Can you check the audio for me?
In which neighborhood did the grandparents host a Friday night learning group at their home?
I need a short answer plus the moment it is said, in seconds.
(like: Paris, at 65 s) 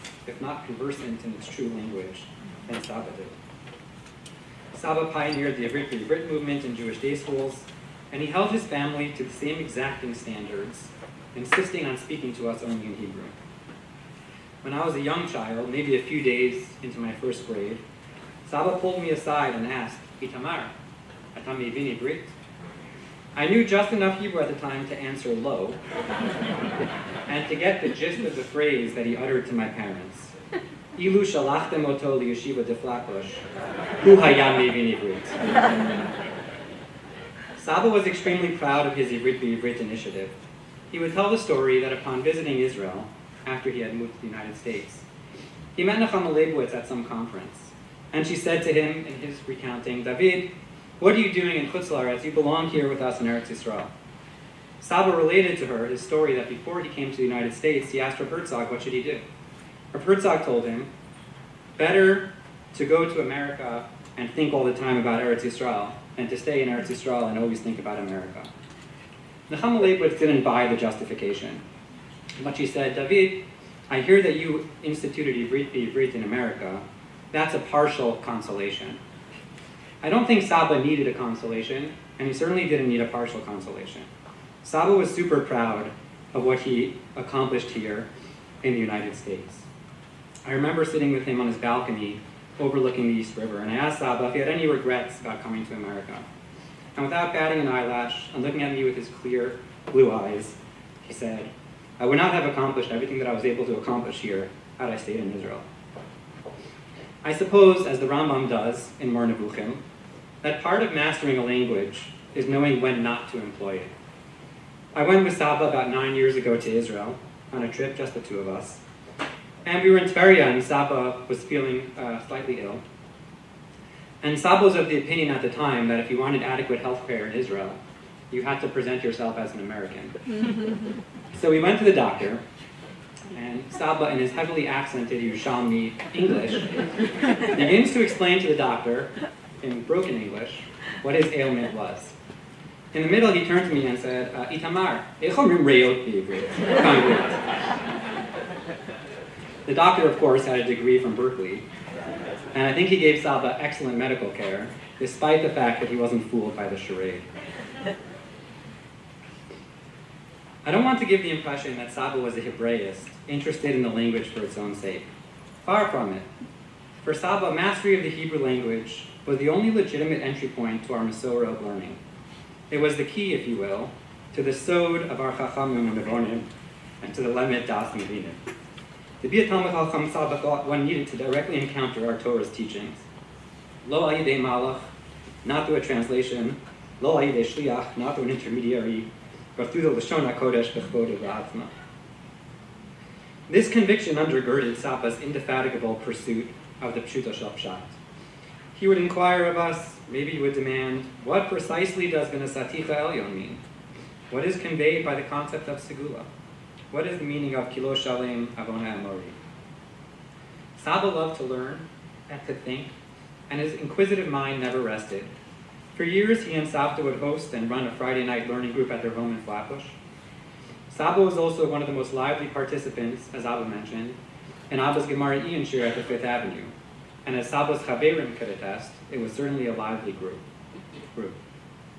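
Flatbush, at 219 s.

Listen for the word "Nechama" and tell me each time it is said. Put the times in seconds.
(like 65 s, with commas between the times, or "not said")
45 s, 69 s.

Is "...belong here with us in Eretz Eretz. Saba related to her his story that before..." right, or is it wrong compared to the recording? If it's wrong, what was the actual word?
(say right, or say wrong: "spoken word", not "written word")
wrong: "Yisrael", not "Eretz".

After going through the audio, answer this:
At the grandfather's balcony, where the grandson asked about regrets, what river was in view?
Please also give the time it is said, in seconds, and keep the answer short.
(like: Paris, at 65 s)
East River, at 93 s.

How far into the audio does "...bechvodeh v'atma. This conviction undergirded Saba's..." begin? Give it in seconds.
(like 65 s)
190 s.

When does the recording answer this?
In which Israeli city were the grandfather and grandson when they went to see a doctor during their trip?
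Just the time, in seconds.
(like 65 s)
120 s.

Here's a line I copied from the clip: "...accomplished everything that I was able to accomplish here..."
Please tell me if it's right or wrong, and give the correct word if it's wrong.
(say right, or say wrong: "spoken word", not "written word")
right.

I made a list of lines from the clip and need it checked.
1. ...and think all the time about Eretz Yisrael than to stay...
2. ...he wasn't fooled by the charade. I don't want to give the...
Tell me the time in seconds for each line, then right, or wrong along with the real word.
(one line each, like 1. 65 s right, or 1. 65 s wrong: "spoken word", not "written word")
1. 64 s right
2. 155 s right.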